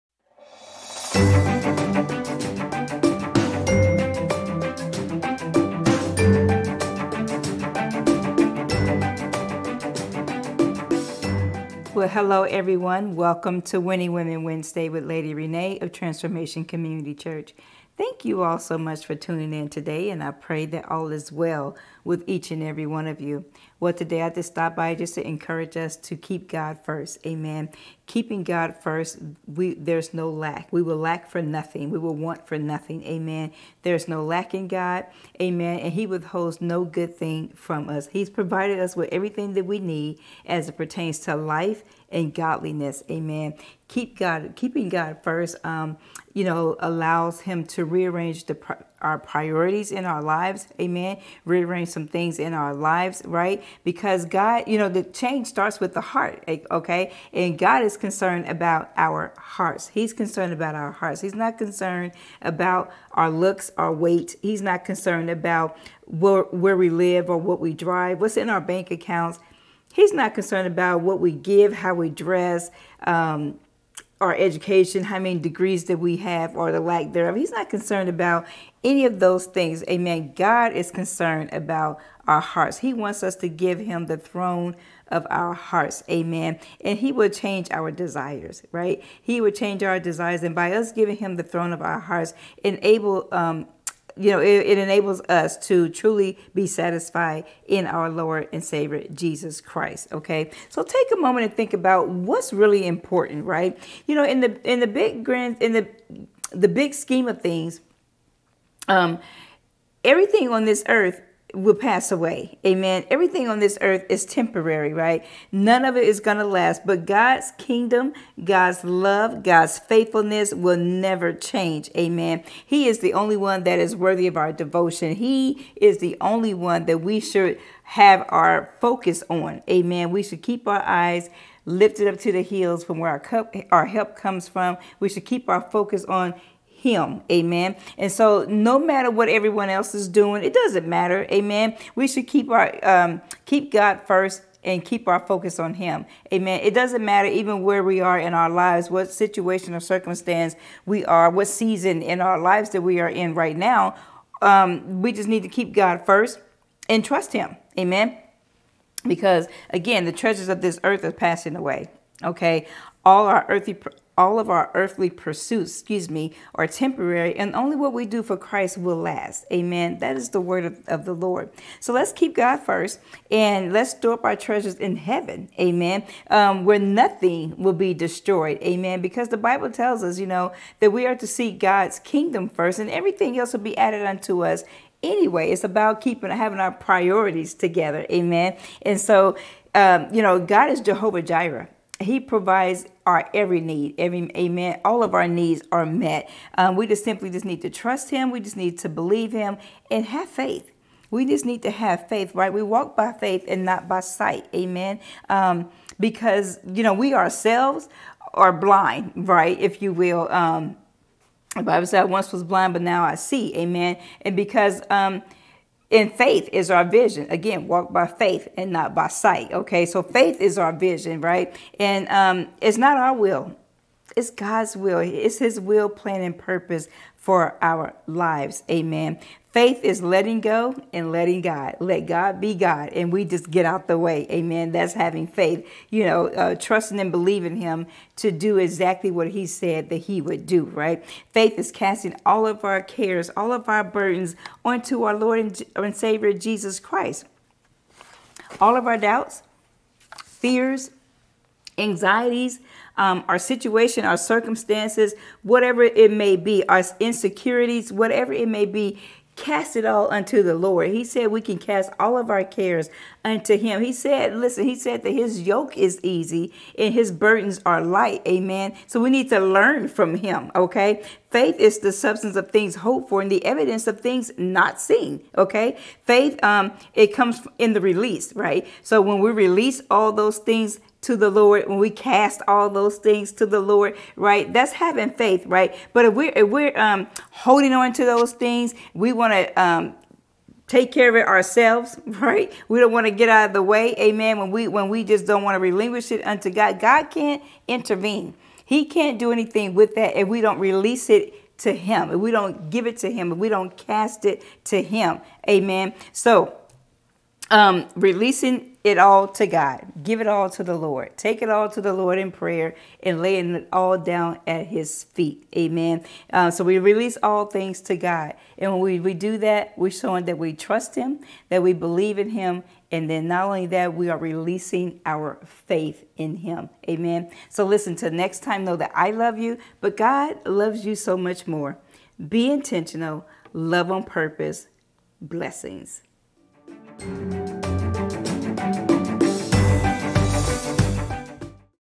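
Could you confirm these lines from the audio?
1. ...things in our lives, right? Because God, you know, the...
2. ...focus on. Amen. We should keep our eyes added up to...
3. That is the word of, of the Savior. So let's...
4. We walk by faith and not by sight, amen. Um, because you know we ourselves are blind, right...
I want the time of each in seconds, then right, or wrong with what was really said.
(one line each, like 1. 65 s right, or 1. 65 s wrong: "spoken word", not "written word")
1. 52 s right
2. 128 s wrong: "lifted", not "added"
3. 169 s wrong: "Lord", not "Savior"
4. 202 s right.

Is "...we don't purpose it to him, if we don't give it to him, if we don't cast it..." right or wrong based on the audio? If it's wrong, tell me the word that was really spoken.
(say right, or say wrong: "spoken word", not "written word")
wrong: "release", not "purpose".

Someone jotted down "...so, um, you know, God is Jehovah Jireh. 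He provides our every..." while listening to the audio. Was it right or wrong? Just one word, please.
right.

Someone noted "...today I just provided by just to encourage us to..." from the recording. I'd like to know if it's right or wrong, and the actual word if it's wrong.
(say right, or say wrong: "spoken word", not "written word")
wrong: "stopped", not "provided".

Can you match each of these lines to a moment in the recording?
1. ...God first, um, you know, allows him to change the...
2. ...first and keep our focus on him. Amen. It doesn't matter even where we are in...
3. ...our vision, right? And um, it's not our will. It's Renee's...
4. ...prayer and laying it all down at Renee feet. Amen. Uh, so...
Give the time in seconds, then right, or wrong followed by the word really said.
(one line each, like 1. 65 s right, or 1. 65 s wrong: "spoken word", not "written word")
1. 44 s wrong: "rearrange", not "change"
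2. 144 s right
3. 220 s wrong: "God", not "Renee"
4. 312 s wrong: "His", not "Renee".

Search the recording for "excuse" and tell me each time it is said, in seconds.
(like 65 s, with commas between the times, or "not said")
165 s.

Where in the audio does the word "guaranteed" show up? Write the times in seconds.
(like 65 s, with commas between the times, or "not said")
not said.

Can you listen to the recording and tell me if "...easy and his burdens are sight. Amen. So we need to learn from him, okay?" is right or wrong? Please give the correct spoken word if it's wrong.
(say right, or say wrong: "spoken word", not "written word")
wrong: "light", not "sight".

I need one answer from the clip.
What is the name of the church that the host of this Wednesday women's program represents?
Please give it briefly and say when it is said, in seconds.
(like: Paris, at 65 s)
Transformation Community Church, at 15 s.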